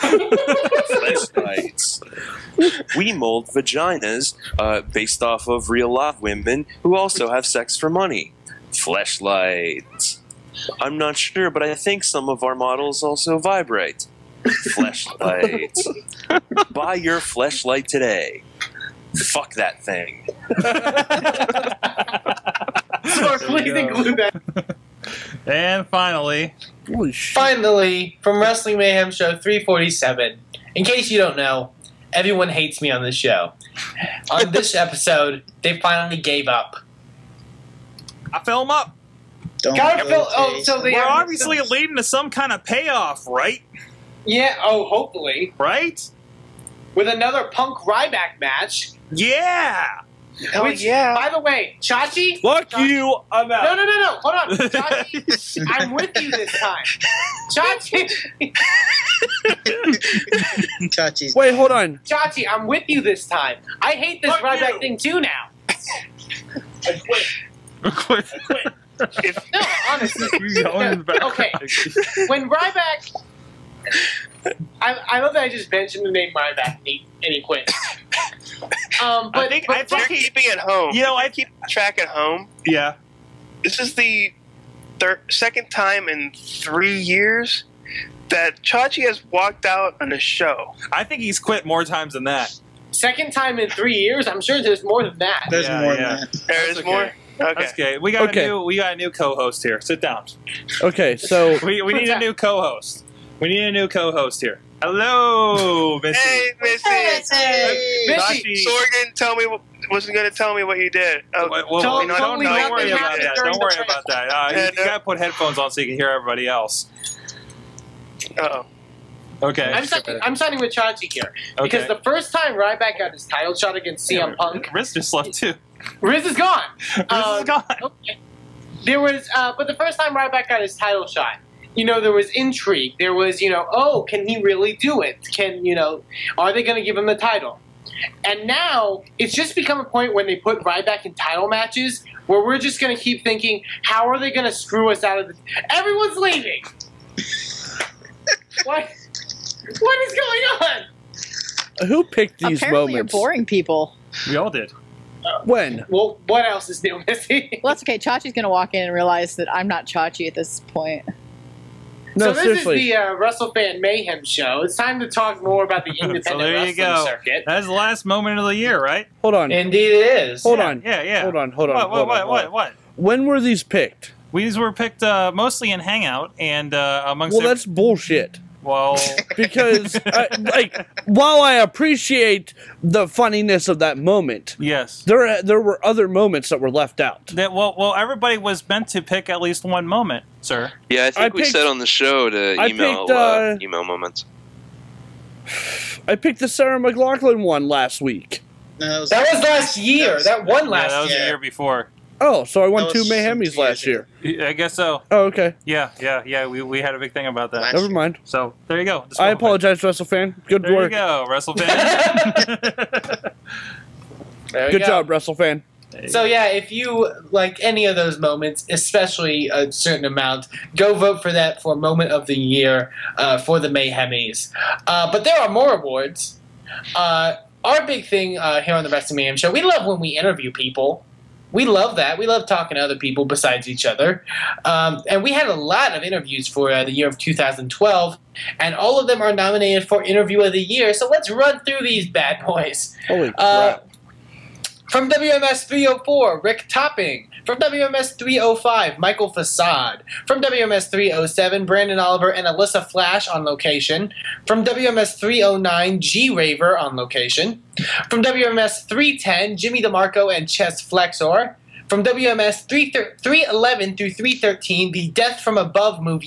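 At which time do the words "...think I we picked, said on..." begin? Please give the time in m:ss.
3:11.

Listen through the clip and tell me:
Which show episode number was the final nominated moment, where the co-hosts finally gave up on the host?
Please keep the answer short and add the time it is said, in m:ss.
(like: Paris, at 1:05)
347, at 0:29.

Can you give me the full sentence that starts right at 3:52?
We love talking to other people besides each other.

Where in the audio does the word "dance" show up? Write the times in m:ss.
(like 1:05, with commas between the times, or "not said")
not said.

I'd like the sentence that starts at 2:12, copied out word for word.
There was, you know, oh, can he really do it?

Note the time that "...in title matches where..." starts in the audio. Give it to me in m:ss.
2:21.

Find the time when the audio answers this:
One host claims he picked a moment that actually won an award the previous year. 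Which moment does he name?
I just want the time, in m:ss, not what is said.
3:16.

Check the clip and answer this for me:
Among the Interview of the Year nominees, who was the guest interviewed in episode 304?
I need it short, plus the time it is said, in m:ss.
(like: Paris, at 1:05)
Rick Topping, at 4:06.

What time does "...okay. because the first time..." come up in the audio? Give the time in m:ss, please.
2:01.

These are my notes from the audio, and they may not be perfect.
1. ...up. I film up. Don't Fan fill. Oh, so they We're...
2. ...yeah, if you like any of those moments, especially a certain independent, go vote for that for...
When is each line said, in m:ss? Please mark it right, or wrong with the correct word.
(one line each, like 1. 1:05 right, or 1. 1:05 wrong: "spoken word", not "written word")
1. 0:36 wrong: "Gotta", not "Fan"
2. 3:36 wrong: "amount", not "independent".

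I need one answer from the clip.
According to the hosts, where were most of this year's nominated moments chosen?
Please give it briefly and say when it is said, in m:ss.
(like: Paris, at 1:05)
Hangout, at 2:55.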